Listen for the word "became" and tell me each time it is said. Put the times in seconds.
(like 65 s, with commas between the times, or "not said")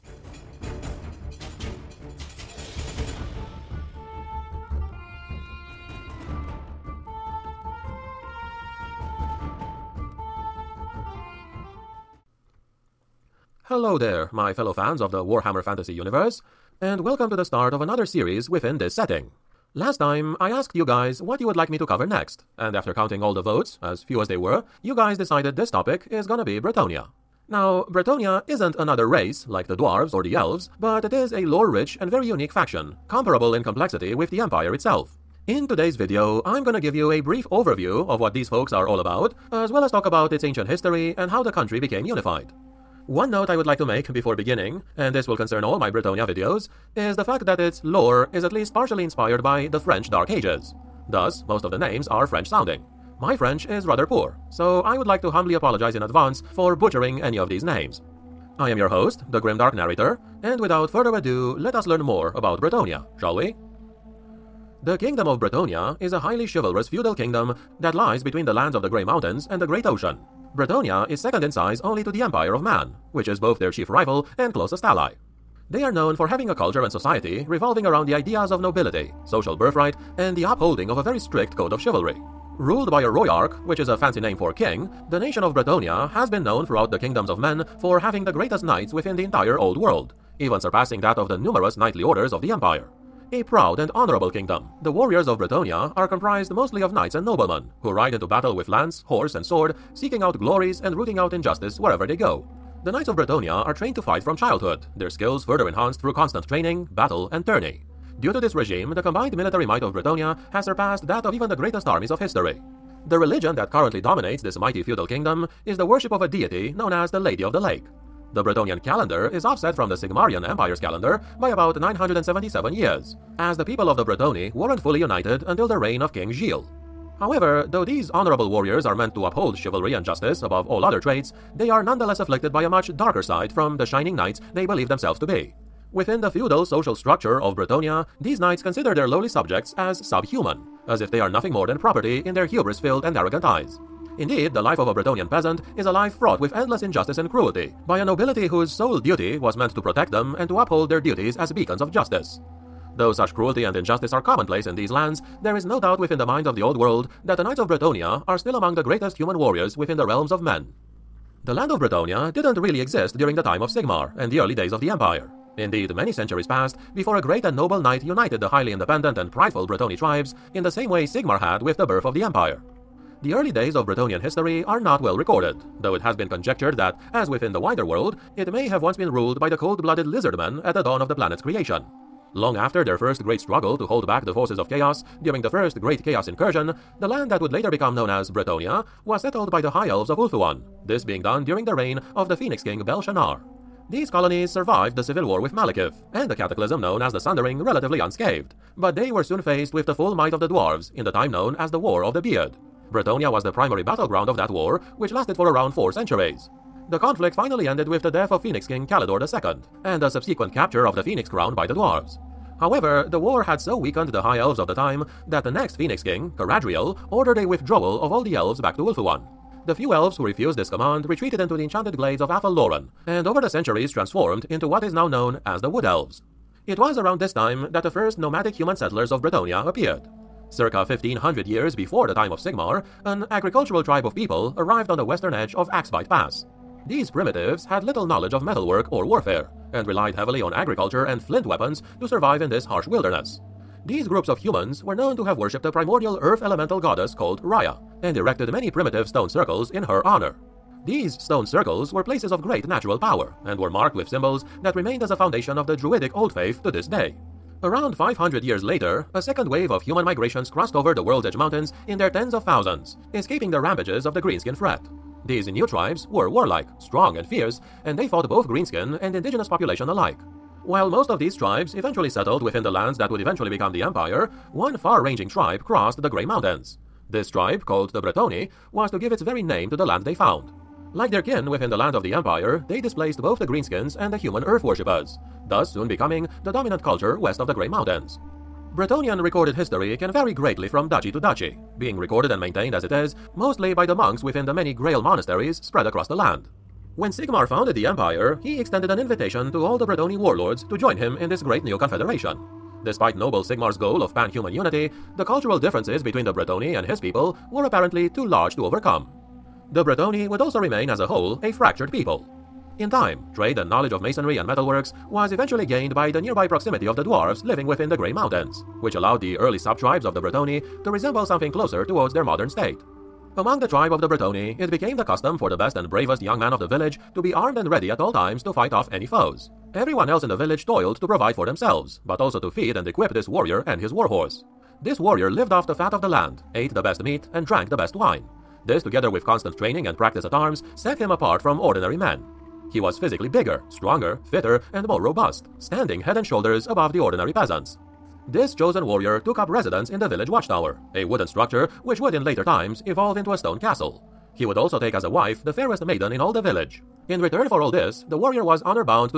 41 s, 324 s.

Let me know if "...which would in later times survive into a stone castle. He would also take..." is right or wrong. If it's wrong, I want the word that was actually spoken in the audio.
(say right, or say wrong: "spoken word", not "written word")
wrong: "evolve", not "survive".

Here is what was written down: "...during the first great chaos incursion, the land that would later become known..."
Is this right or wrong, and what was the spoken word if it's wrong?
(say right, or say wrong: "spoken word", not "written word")
right.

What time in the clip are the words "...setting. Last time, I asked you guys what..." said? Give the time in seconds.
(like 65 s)
18 s.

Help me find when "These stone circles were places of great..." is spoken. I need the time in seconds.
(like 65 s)
250 s.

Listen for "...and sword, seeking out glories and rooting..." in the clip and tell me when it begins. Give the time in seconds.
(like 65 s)
99 s.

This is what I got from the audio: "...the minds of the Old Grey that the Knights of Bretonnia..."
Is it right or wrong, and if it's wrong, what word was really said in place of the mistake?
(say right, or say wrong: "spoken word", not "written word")
wrong: "World", not "Grey".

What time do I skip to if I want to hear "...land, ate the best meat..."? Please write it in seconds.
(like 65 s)
336 s.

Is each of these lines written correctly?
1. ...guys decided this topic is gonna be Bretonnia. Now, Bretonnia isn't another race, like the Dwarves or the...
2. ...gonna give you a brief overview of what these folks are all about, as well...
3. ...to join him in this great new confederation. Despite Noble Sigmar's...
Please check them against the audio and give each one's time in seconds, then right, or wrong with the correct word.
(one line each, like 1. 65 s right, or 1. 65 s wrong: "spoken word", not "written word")
1. 24 s right
2. 36 s right
3. 300 s right.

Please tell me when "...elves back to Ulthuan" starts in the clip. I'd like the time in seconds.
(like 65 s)
218 s.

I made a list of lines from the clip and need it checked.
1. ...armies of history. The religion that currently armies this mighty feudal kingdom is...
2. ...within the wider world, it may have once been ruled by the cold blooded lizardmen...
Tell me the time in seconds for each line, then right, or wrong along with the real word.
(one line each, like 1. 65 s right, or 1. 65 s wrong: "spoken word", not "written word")
1. 111 s wrong: "dominates", not "armies"
2. 177 s right.